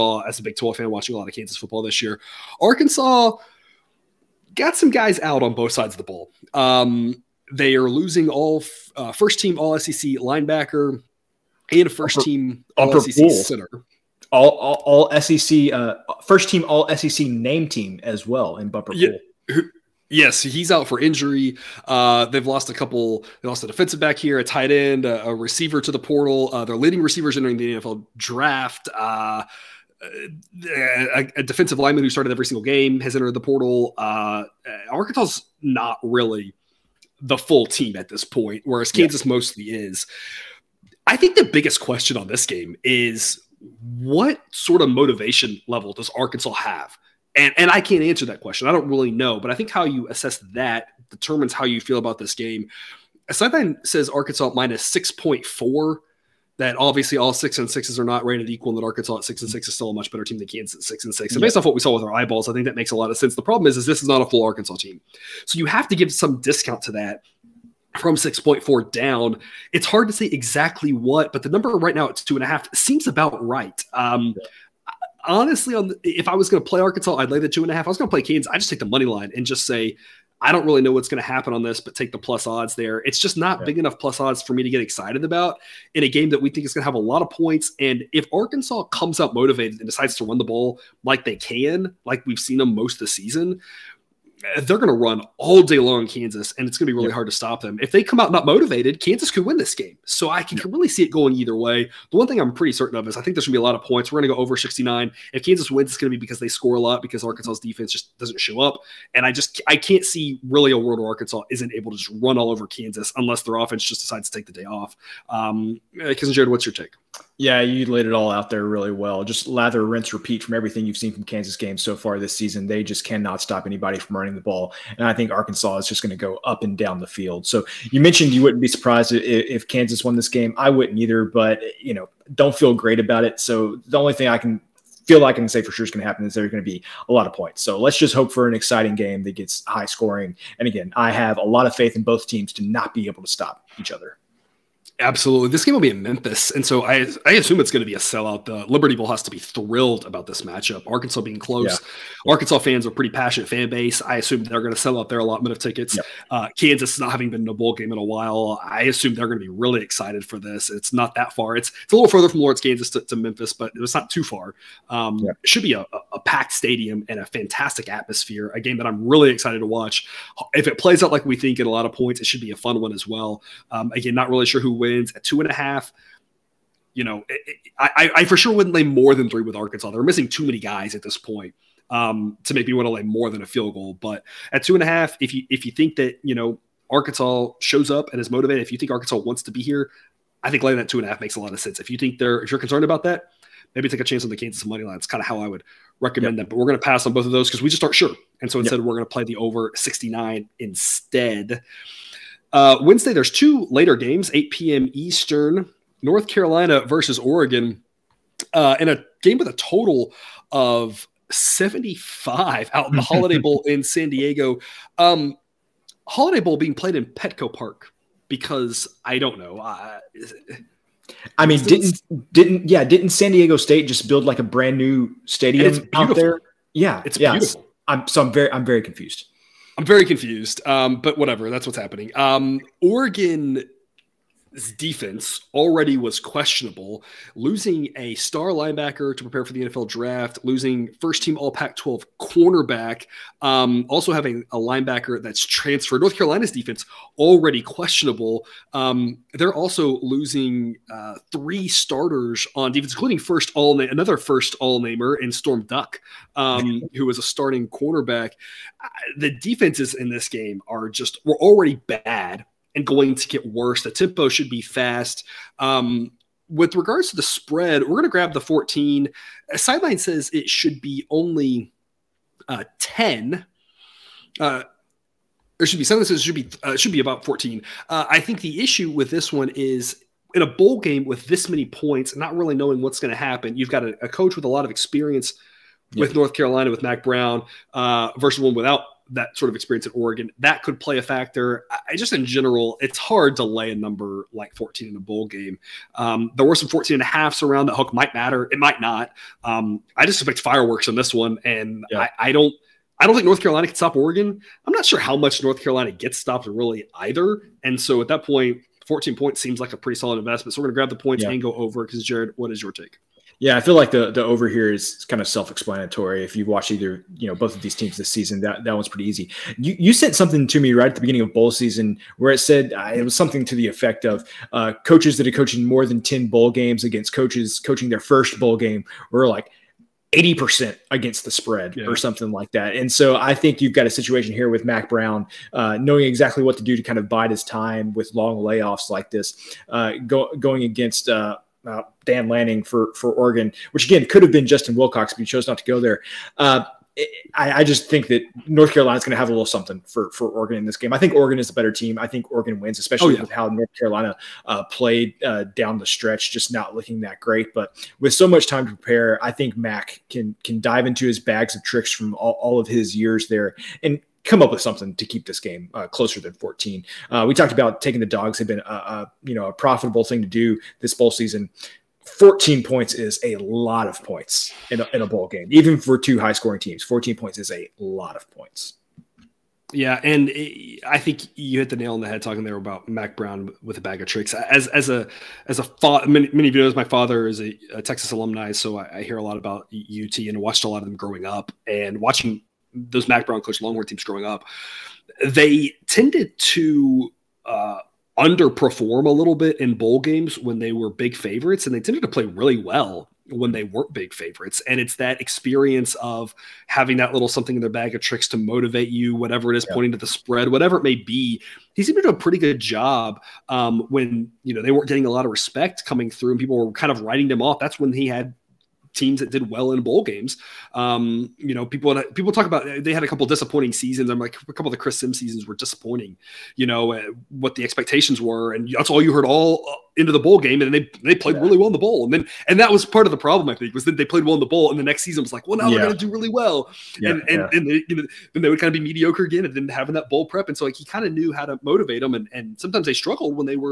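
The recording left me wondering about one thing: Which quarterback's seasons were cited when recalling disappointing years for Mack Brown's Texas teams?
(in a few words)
Chris Simms.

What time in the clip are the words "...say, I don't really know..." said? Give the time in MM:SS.
01:19.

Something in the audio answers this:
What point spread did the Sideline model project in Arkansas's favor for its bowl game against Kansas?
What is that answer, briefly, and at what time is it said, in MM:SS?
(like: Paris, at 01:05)
6.4, at 00:54.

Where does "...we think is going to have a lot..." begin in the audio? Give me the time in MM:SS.
01:26.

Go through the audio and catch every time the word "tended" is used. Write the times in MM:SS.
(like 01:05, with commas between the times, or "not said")
06:35, 06:41.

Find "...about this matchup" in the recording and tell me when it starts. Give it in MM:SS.
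02:30.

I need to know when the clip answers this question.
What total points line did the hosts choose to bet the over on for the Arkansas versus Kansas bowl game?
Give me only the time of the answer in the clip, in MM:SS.
01:44.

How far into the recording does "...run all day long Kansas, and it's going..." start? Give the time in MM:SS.
01:34.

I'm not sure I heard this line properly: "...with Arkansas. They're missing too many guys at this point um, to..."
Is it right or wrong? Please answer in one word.
right.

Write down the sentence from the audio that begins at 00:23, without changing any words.
They lost a defensive back here, a tight end, a, a receiver to the portal.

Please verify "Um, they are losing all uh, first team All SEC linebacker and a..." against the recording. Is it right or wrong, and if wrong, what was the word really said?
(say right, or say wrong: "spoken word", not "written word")
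right.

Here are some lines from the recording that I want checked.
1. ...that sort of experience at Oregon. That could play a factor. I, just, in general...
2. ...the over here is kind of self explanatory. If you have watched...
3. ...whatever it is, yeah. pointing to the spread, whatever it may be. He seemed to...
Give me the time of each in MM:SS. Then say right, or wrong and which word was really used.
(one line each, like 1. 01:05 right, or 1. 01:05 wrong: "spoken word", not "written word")
1. 04:49 right
2. 05:14 right
3. 06:49 right.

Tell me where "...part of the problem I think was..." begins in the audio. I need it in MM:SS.
07:12.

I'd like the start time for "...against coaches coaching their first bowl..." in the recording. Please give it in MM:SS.
05:26.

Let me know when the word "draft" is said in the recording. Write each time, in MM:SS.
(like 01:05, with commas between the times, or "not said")
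00:28, 03:59.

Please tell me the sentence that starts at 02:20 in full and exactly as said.
And again, I have a lot of faith in both teams to not be able to stop each other.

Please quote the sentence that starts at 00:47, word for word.
And, and I can't answer that question.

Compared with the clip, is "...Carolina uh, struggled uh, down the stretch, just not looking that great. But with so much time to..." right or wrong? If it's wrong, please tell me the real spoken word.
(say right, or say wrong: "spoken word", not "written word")
wrong: "played", not "struggled".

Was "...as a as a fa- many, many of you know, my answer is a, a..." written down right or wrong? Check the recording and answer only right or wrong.
wrong.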